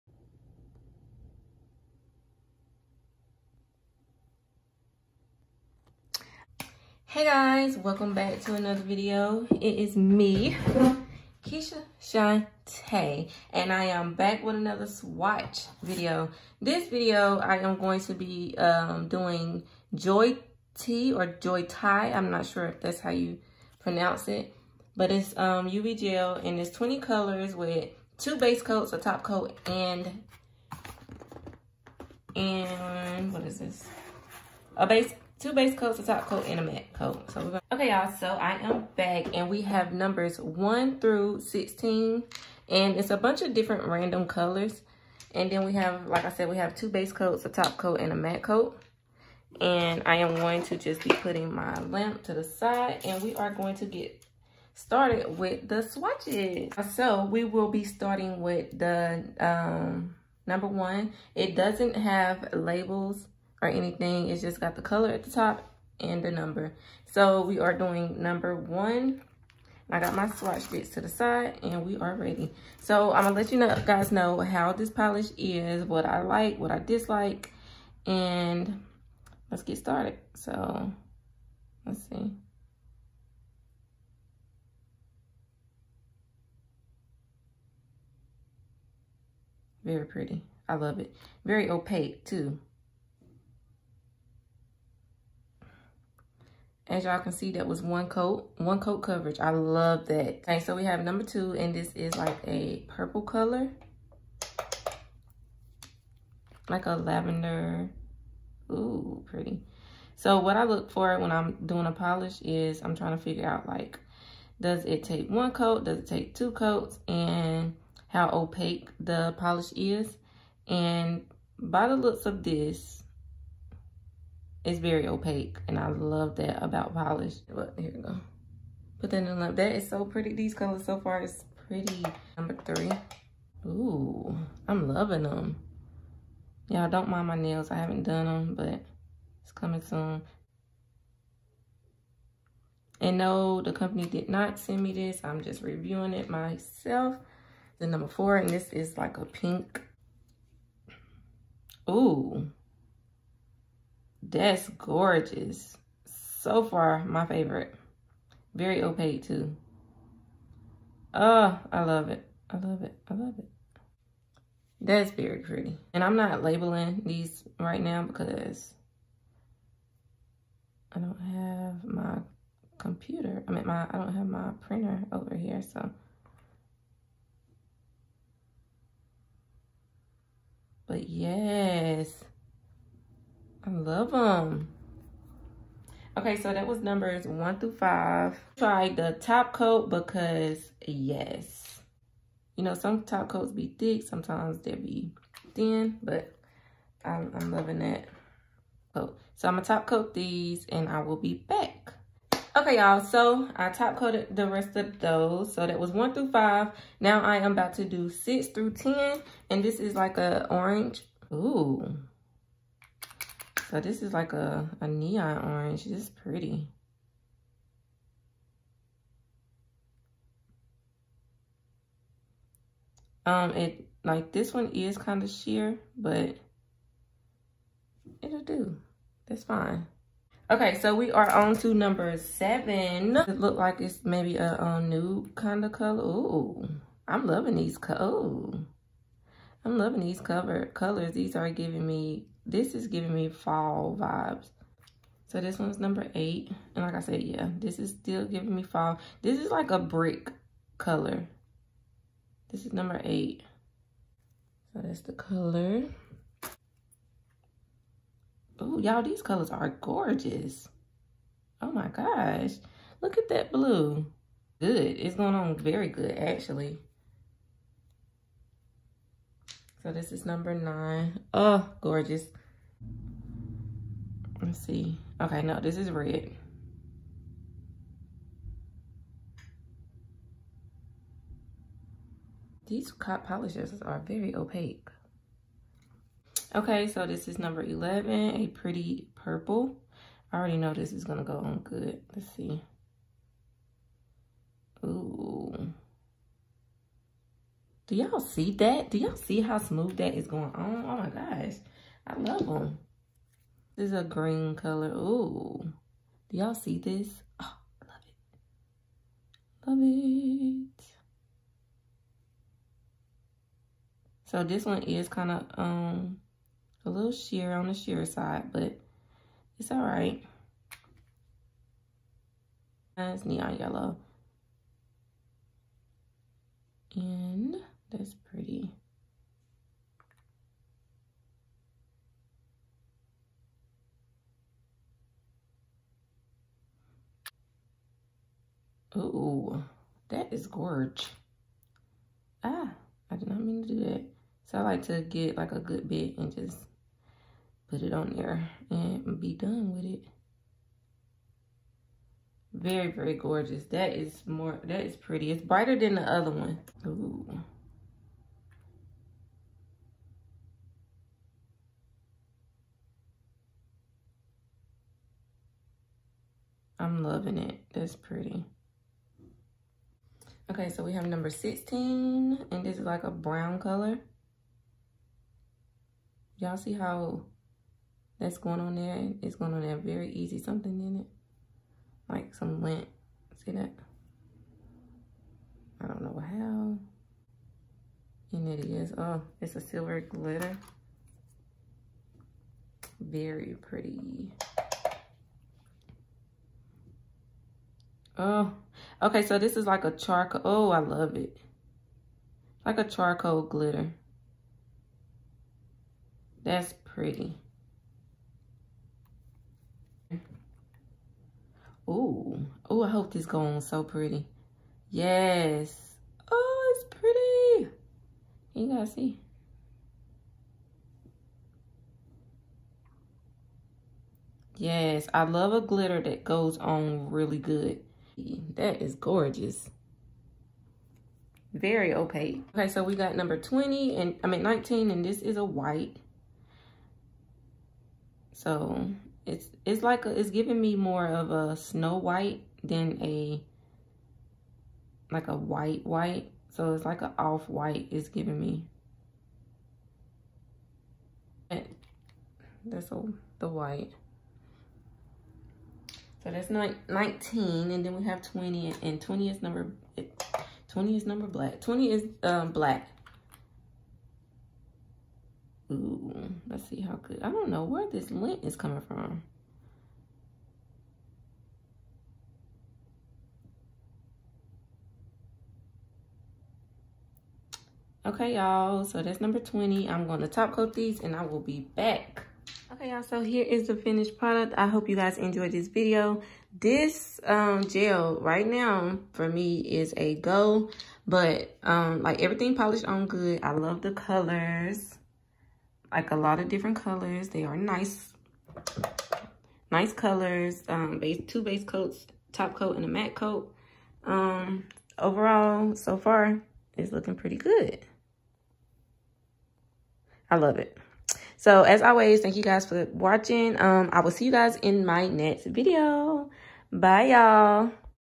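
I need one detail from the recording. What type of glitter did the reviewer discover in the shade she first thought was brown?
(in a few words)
silver glitter.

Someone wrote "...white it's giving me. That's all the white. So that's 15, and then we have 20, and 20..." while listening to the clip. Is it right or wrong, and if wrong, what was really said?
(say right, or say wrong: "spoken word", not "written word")
wrong: "19", not "15".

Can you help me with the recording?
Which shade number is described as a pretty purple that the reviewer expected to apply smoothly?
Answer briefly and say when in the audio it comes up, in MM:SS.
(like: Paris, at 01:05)
11, at 04:47.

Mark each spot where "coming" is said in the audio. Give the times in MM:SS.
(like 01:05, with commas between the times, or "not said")
02:19, 07:48.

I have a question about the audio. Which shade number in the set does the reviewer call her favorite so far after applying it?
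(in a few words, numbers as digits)
4.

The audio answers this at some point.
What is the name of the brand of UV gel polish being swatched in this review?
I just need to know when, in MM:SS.
00:19.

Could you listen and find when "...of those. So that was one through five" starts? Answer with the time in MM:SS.
03:24.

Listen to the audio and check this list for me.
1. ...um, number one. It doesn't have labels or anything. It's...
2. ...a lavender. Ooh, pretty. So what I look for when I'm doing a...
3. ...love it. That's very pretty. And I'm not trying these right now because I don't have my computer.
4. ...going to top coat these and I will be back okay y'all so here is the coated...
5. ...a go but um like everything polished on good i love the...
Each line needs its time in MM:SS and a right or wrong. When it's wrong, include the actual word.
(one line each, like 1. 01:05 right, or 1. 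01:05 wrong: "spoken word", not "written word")
1. 00:59 right
2. 01:46 right
3. 02:43 wrong: "labeling", not "trying"
4. 08:00 wrong: "finished", not "coated"
5. 08:09 right.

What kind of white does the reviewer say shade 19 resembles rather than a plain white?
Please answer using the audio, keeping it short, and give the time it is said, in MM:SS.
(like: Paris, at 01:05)
snow white, at 07:21.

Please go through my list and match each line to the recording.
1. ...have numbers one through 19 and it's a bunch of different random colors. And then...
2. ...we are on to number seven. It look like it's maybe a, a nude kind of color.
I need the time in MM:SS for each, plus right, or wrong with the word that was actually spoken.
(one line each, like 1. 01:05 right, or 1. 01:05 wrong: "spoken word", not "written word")
1. 00:39 wrong: "16", not "19"
2. 03:50 right.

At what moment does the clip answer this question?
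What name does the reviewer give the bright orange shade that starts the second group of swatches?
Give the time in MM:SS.
03:34.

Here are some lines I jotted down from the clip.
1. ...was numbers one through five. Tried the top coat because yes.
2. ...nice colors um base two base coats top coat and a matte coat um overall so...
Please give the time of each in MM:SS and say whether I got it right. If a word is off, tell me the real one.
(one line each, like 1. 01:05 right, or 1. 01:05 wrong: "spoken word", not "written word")
1. 03:06 right
2. 08:19 right.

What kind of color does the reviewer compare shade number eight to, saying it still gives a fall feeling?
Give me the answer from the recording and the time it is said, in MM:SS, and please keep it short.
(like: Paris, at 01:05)
brick, at 04:09.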